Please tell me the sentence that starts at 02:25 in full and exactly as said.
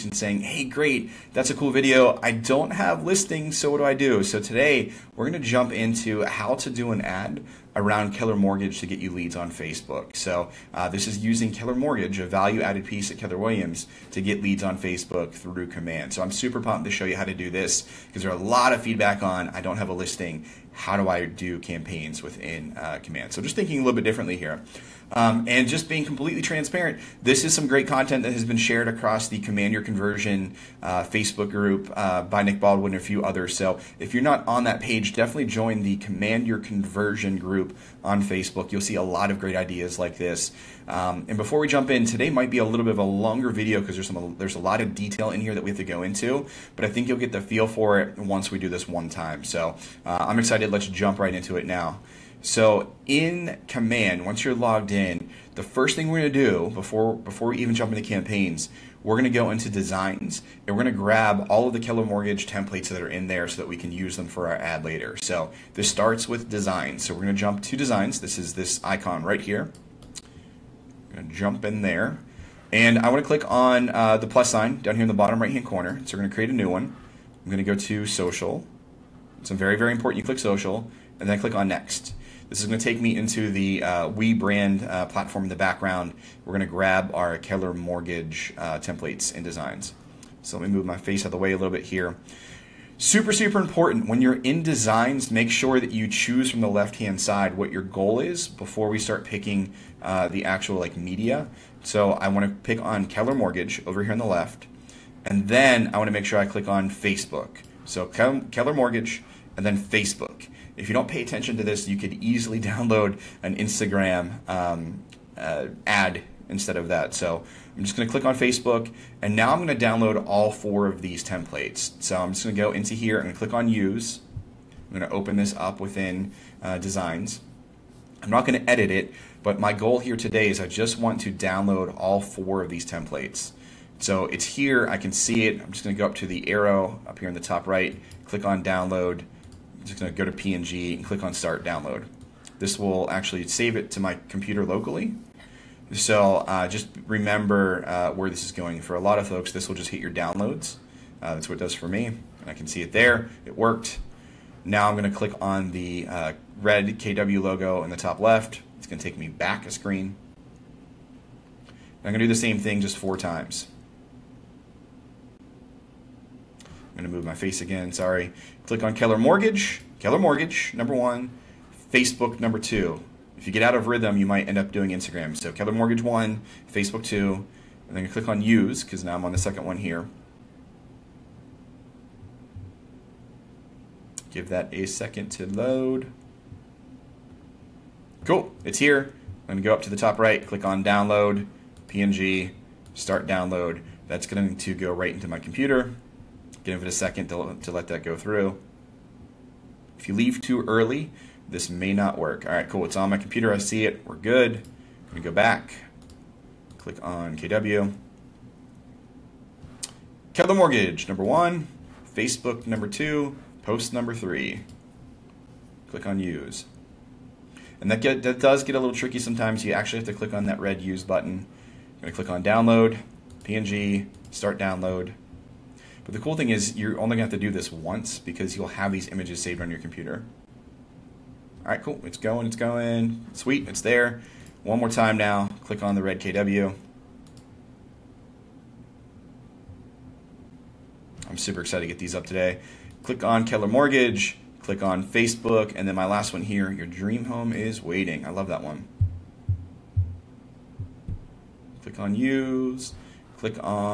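So uh, just remember uh, where this is going.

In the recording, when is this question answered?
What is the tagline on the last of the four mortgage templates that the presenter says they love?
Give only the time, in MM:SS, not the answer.
04:06.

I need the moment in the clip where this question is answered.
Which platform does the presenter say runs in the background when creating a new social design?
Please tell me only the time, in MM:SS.
01:24.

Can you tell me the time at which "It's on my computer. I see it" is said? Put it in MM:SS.
03:22.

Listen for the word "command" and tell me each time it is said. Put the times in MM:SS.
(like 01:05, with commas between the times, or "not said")
00:15, 00:23, 00:29, 00:35, 00:53.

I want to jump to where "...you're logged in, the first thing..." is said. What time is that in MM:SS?
00:54.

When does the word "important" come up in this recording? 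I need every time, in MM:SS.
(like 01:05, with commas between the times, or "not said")
01:19, 01:33.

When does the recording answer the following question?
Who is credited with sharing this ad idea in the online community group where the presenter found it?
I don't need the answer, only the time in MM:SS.
00:32.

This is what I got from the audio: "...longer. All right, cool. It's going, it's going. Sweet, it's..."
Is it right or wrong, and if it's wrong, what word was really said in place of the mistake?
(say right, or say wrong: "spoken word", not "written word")
wrong: "computer", not "longer".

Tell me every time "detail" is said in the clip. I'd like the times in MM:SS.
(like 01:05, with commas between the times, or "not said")
00:44.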